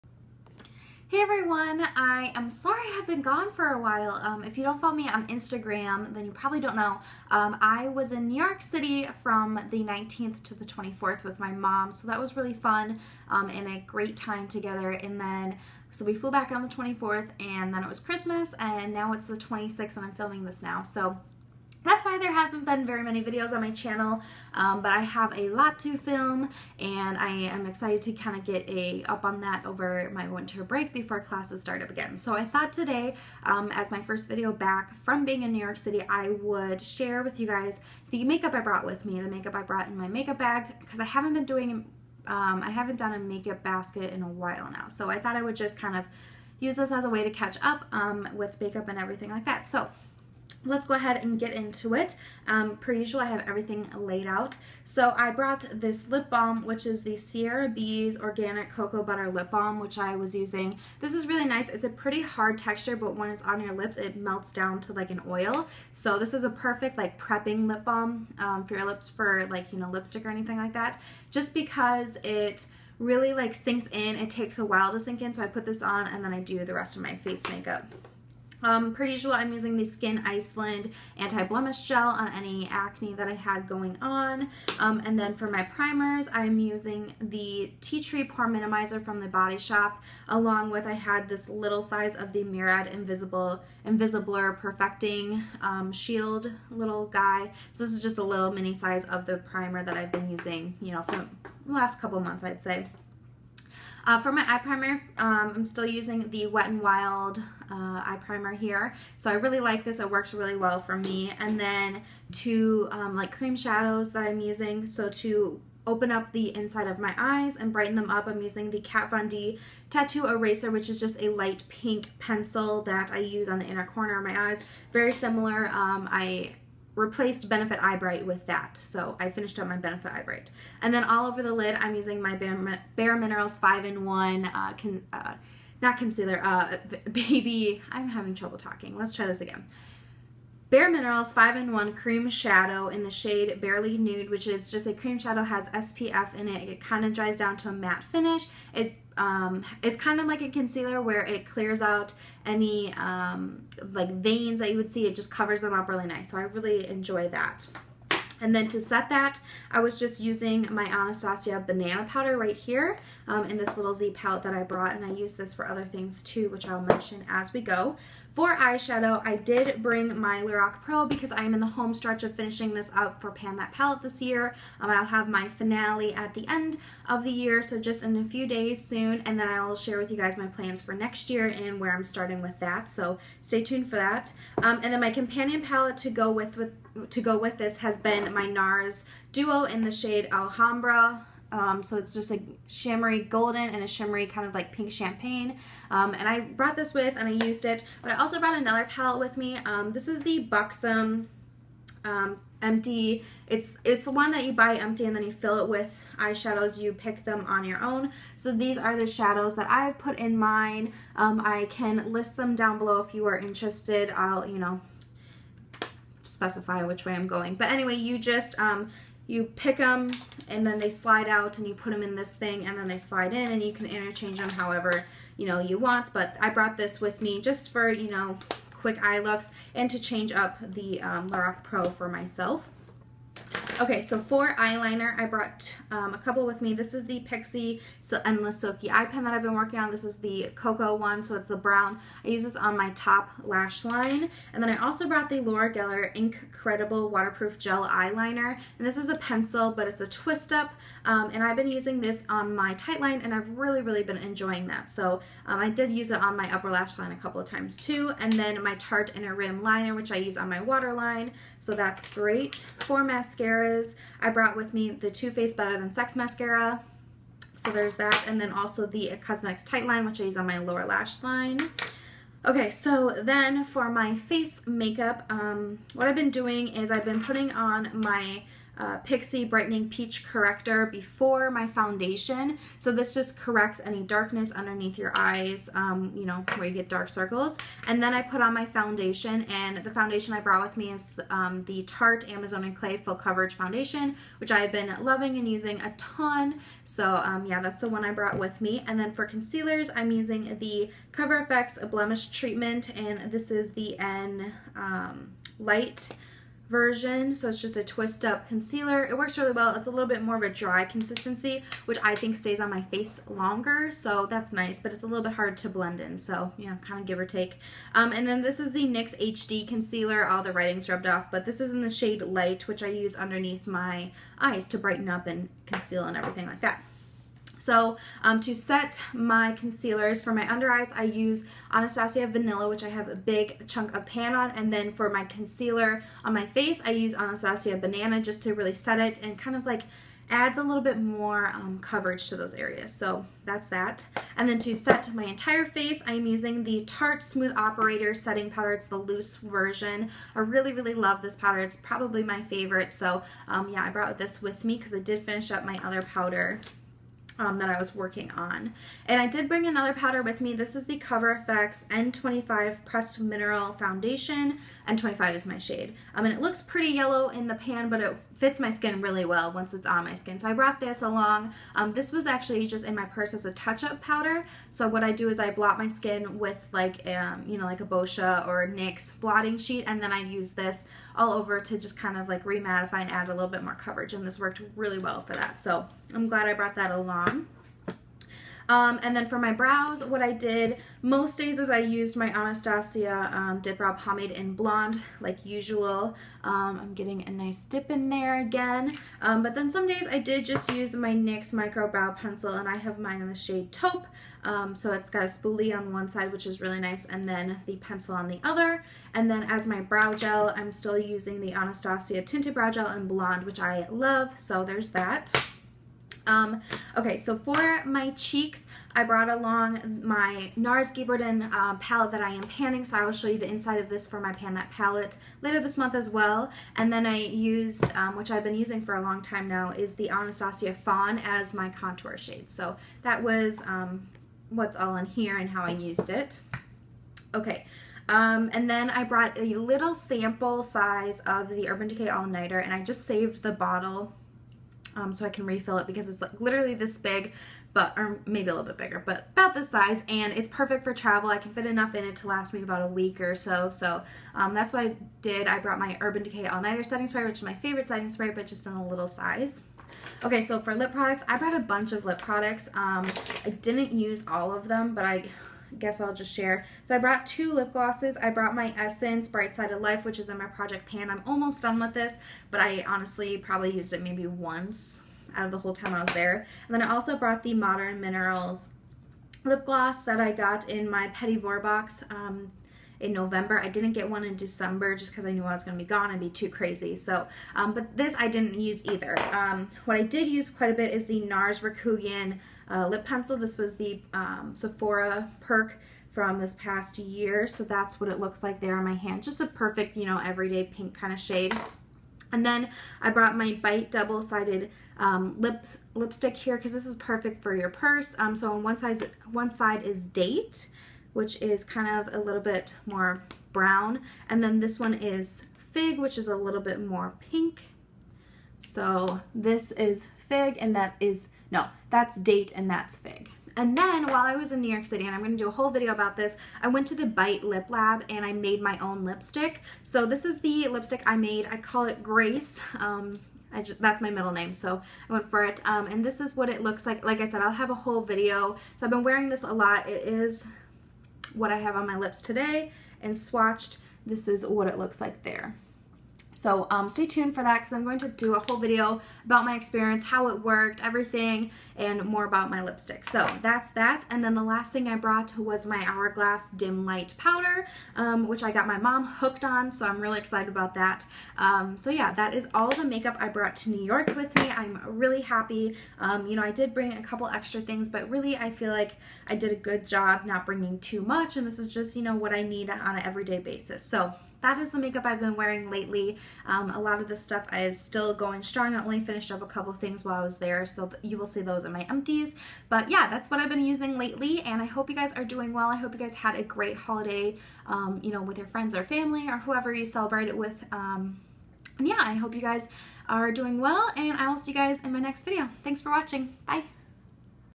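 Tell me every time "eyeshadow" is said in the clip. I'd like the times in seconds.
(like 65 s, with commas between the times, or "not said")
168 s, 206 s.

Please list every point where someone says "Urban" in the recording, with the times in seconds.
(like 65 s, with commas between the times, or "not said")
441 s, 456 s.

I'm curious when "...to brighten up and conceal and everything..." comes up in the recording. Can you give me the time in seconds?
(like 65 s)
324 s.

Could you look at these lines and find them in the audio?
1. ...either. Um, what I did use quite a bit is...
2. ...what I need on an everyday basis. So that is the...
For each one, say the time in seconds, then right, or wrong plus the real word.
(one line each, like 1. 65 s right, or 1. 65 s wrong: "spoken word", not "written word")
1. 488 s right
2. 572 s right.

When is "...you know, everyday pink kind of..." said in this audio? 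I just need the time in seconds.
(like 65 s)
499 s.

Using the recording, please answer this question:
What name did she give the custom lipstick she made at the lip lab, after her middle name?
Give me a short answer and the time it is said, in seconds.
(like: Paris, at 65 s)
Grace, at 532 s.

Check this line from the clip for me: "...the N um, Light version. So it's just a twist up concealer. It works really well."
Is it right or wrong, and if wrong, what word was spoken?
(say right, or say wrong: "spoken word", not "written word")
right.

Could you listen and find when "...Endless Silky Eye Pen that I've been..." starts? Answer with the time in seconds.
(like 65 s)
238 s.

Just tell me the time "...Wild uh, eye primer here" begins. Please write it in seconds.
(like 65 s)
106 s.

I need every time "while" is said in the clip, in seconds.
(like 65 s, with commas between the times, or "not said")
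3 s, 44 s, 74 s, 524 s, 580 s.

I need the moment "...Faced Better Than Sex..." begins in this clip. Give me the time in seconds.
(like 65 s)
265 s.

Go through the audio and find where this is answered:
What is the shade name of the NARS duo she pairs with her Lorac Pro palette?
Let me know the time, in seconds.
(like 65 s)
190 s.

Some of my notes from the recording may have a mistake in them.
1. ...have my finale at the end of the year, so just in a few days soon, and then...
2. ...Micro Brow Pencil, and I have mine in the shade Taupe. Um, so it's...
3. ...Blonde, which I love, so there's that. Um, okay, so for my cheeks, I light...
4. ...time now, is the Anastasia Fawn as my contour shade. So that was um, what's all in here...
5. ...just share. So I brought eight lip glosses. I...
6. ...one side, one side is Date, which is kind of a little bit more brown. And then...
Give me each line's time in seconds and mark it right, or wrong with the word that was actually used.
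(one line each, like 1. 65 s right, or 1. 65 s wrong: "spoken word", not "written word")
1. 175 s right
2. 401 s right
3. 413 s wrong: "brought", not "light"
4. 429 s right
5. 466 s wrong: "two", not "eight"
6. 508 s right.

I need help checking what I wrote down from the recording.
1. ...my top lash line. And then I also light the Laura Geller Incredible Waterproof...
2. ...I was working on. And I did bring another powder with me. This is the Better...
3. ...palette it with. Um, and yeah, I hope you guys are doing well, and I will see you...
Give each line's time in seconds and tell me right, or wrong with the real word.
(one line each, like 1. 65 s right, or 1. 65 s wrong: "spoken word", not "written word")
1. 242 s wrong: "brought", not "light"
2. 357 s wrong: "Cover", not "Better"
3. 589 s wrong: "celebrate", not "palette".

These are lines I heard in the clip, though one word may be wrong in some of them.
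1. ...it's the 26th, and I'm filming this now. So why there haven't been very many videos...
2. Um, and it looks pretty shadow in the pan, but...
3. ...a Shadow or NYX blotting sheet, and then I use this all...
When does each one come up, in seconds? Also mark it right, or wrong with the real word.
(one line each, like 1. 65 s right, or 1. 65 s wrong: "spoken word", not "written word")
1. 19 s right
2. 366 s wrong: "yellow", not "shadow"
3. 377 s wrong: "Boscia", not "Shadow".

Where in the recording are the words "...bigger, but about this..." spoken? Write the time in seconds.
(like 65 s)
448 s.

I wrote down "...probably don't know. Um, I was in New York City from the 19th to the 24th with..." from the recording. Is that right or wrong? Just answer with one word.
right.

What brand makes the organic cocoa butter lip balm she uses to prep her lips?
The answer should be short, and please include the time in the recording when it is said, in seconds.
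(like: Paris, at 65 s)
Sierra Bees, at 57 s.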